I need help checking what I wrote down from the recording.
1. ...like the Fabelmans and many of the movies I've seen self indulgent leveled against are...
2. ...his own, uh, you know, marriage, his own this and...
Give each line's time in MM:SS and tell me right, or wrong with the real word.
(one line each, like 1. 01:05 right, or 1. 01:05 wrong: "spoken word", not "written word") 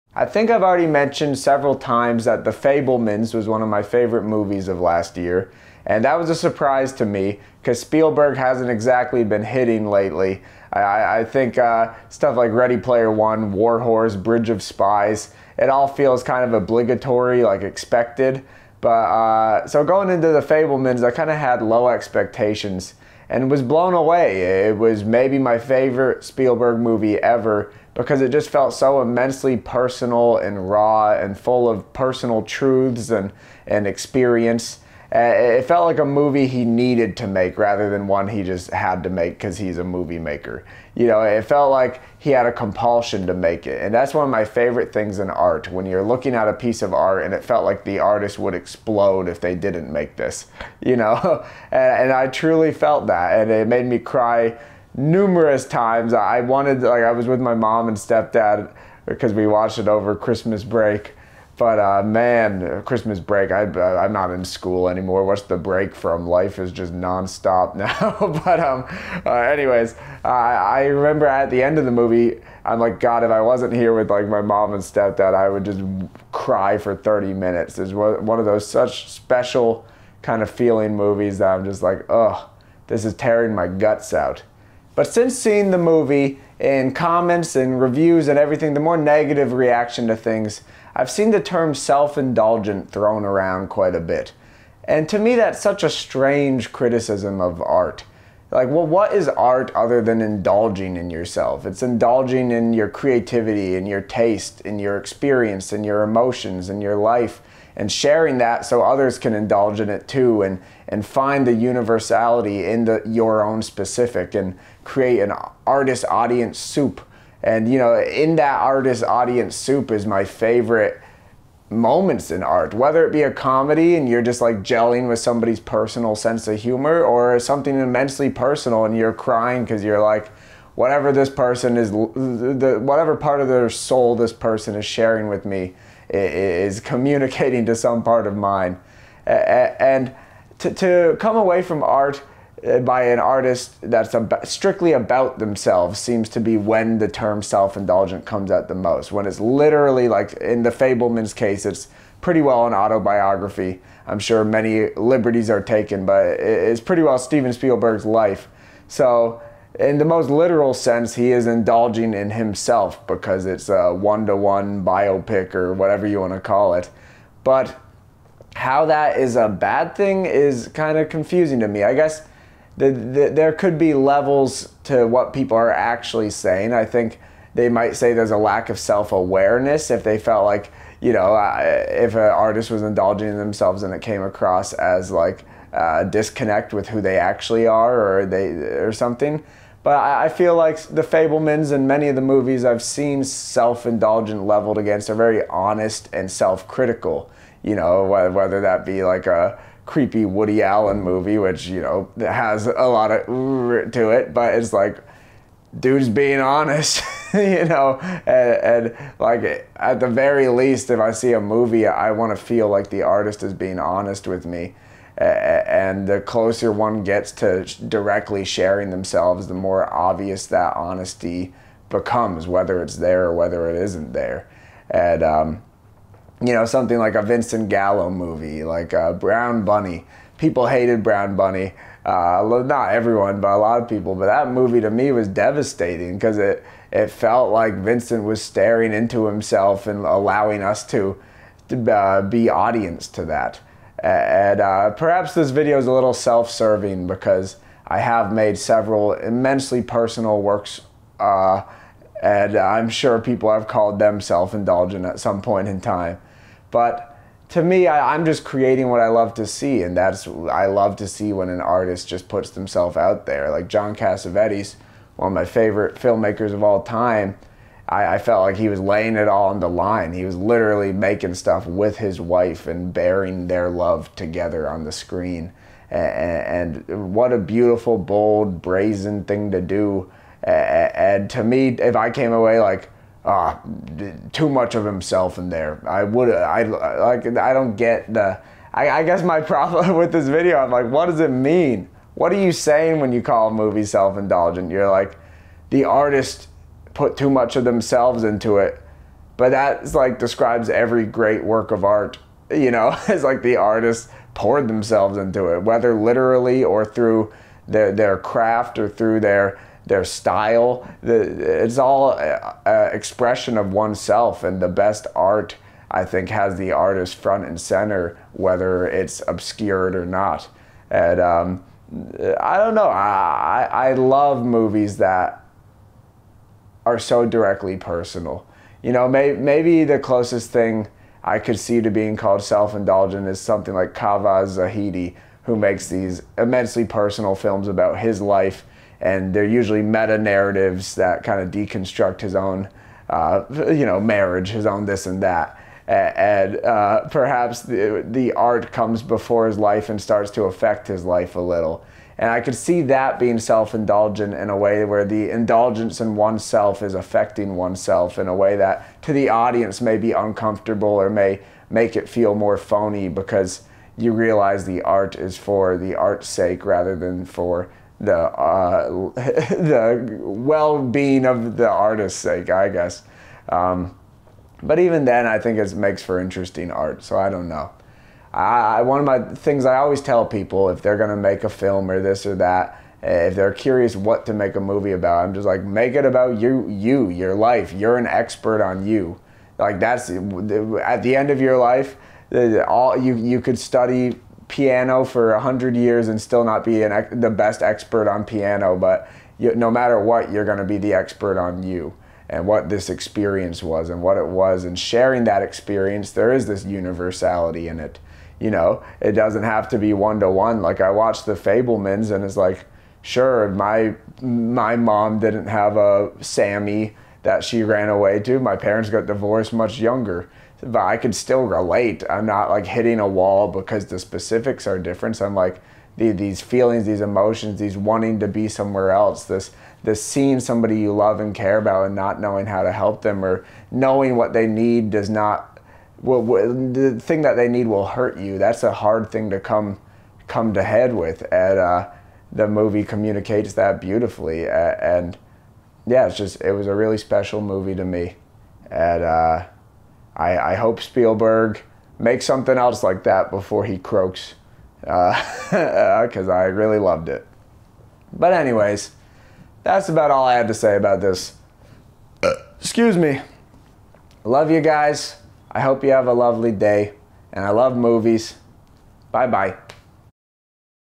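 1. 03:10 right
2. 05:42 right.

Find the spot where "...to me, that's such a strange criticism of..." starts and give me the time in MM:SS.
01:35.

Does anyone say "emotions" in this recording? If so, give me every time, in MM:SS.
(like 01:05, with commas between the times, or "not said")
01:46, 07:07.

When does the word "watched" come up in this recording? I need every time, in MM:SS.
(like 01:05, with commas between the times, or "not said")
00:59, 06:50.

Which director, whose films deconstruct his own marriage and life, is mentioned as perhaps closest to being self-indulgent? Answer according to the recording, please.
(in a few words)
Caveh Zahedi.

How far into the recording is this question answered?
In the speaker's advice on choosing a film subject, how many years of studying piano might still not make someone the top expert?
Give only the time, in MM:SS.
06:35.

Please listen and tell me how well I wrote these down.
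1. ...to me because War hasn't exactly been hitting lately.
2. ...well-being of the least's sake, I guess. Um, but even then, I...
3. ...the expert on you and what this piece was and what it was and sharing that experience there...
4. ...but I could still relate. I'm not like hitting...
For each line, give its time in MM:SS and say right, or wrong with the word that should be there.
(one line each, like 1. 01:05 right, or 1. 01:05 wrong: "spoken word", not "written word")
1. 00:06 wrong: "Spielberg", not "War"
2. 06:10 wrong: "artist", not "least"
3. 06:40 wrong: "experience", not "piece"
4. 07:00 right.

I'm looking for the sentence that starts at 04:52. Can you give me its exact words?
What are you saying when you call a movie self-indulgent?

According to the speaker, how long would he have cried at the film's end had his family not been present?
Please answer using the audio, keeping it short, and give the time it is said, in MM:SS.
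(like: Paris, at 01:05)
30 minutes, at 01:16.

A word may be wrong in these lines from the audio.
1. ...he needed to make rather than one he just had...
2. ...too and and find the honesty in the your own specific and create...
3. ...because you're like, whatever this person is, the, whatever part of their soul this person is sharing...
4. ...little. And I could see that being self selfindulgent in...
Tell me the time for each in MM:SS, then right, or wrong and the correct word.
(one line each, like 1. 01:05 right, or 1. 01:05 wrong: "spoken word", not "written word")
1. 00:36 right
2. 01:50 wrong: "universality", not "honesty"
3. 02:09 right
4. 05:51 wrong: "indulgent", not "selfindulgent".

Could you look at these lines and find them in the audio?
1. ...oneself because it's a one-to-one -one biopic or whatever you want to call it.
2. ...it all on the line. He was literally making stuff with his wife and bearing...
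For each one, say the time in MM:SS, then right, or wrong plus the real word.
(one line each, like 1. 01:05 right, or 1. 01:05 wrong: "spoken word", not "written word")
1. 02:42 wrong: "himself", not "oneself"
2. 04:29 right.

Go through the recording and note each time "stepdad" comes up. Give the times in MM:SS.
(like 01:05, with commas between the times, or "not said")
00:57, 01:14.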